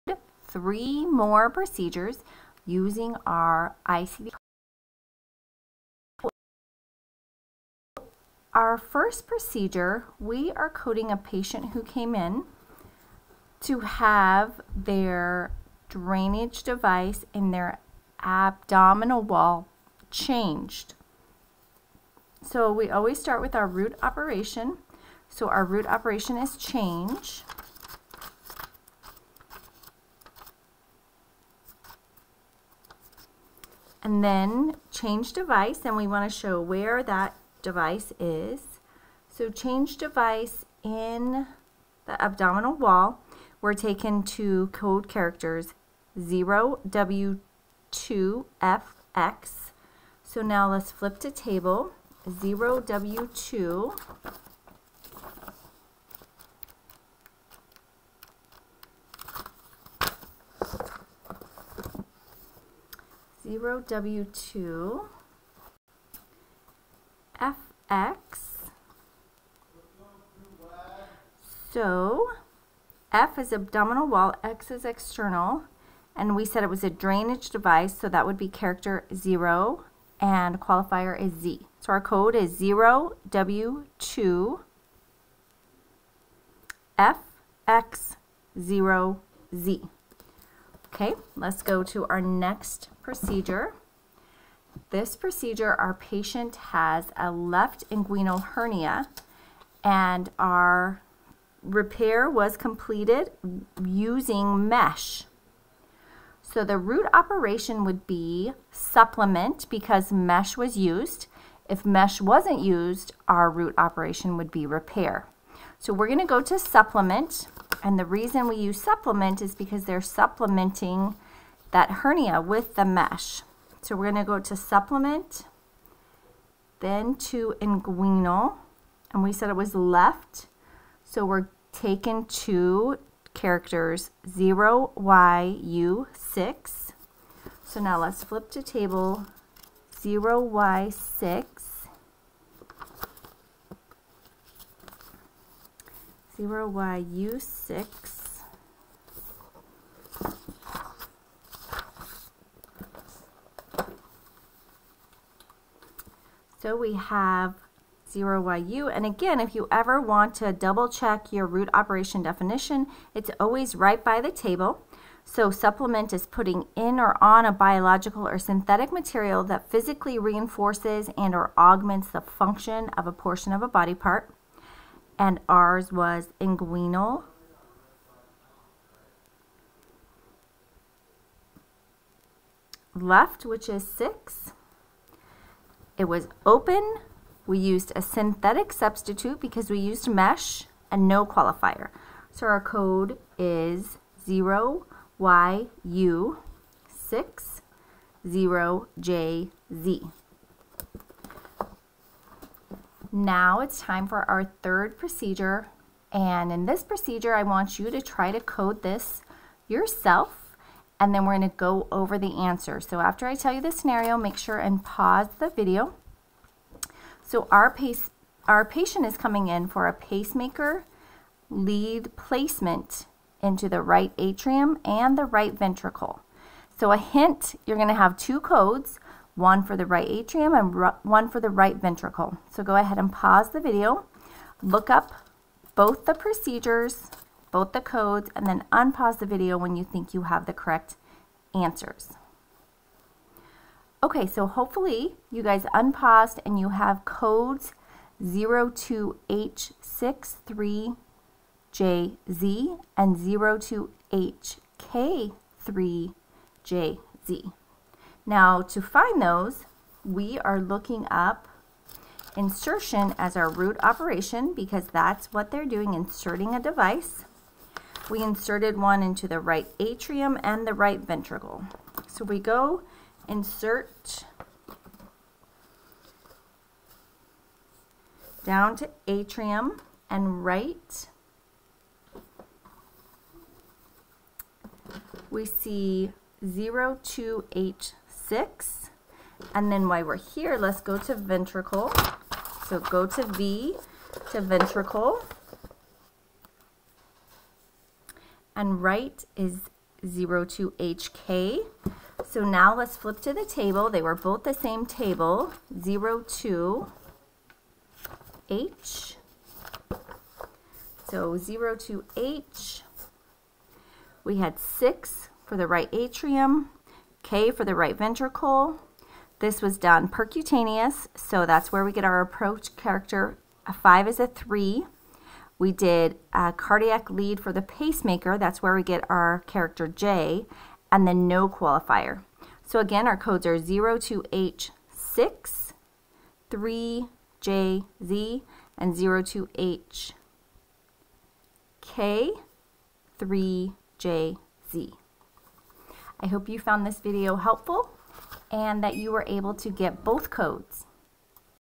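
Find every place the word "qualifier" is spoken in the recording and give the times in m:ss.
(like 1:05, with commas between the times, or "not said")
1:20, 3:11, 5:31.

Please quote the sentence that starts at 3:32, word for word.
So after I tell you the scenario, make sure and pause the video.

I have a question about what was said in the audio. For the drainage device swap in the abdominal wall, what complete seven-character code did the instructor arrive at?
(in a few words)
0W2FX0Z.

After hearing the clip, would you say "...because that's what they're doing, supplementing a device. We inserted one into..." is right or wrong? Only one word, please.
wrong.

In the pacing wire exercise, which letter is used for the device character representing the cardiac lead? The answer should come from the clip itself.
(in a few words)
J.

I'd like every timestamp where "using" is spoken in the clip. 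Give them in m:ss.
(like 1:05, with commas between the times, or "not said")
0:02, 1:43.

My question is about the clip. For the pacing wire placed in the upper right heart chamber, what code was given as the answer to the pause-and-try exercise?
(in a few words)
02H63JZ.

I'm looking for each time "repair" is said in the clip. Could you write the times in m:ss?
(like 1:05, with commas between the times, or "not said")
1:41, 1:54.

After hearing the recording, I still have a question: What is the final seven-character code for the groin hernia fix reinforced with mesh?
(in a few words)
0YU60JZ.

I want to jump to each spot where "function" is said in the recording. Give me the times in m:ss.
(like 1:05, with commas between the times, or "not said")
2:52.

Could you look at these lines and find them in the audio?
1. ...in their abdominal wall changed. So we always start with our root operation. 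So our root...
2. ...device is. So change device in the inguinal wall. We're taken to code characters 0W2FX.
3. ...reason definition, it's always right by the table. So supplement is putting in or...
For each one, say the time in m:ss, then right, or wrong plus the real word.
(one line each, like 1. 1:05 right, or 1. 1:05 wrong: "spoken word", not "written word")
1. 0:17 right
2. 0:37 wrong: "abdominal", not "inguinal"
3. 2:41 wrong: "operation", not "reason".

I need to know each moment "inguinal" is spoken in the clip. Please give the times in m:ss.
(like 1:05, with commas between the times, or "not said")
1:37, 2:07, 2:56.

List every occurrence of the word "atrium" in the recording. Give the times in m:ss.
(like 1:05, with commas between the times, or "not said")
3:44, 3:50, 4:29, 4:39, 5:15.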